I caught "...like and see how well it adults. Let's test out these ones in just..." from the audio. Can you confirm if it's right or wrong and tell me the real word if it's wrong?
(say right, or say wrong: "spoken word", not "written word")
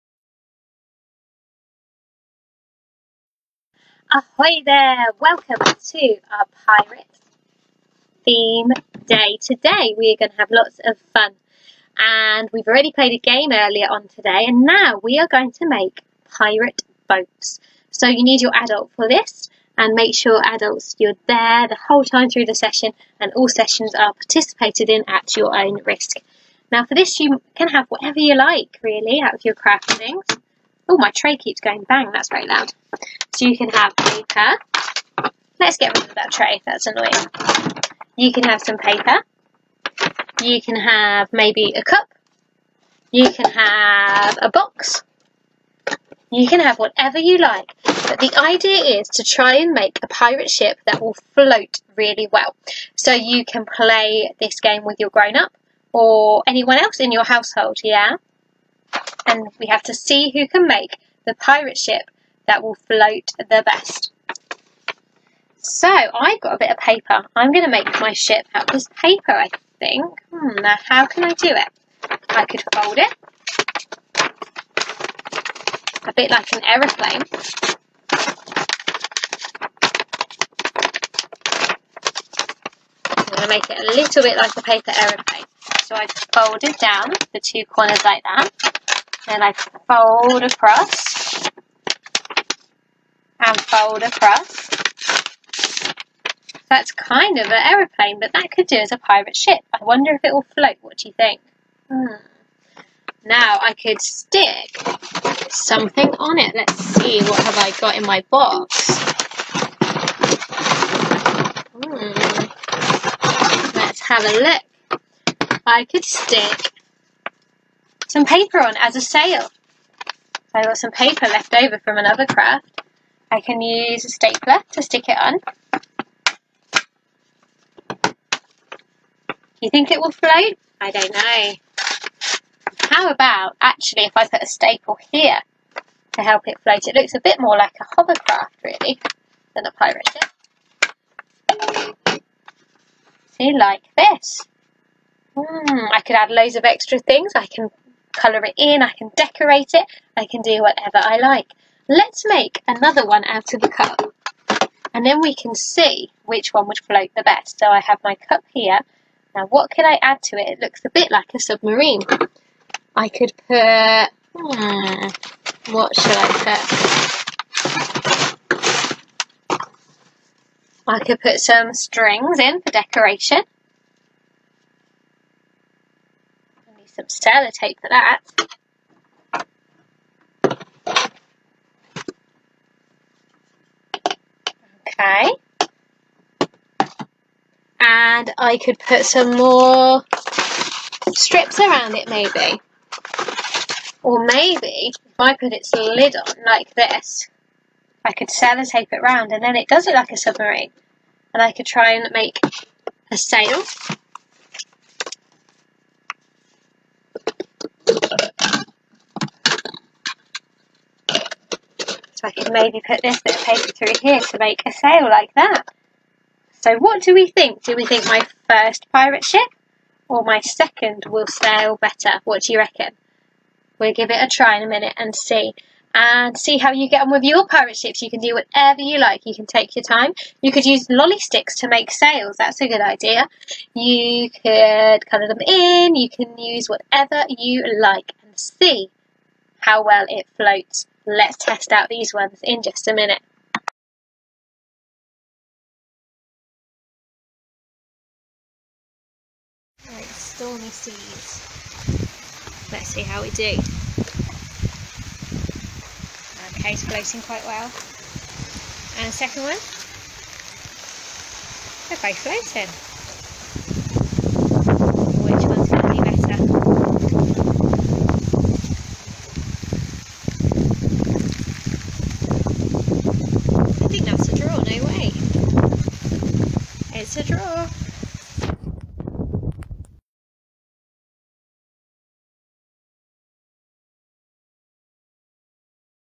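wrong: "floats", not "adults".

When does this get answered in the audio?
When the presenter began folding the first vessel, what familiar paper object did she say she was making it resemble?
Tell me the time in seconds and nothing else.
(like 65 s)
84 s.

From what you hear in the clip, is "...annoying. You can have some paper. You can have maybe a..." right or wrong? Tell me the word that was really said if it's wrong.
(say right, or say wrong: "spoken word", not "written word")
right.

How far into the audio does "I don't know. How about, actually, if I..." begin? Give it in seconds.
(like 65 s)
130 s.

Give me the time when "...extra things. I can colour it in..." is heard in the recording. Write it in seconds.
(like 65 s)
146 s.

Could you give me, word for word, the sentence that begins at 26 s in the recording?
Now for this you can have whatever you like really out of your things.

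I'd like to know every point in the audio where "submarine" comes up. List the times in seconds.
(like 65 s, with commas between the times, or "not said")
161 s, 200 s.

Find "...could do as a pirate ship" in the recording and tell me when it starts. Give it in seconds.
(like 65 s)
98 s.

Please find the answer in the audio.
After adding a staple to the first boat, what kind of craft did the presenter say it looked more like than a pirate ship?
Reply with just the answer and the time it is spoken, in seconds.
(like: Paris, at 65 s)
hovercraft, at 137 s.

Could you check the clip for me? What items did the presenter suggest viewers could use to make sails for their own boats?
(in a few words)
lolly sticks.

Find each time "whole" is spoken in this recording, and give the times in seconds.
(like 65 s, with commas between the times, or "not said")
21 s.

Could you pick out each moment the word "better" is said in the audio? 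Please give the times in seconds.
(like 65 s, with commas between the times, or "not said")
221 s.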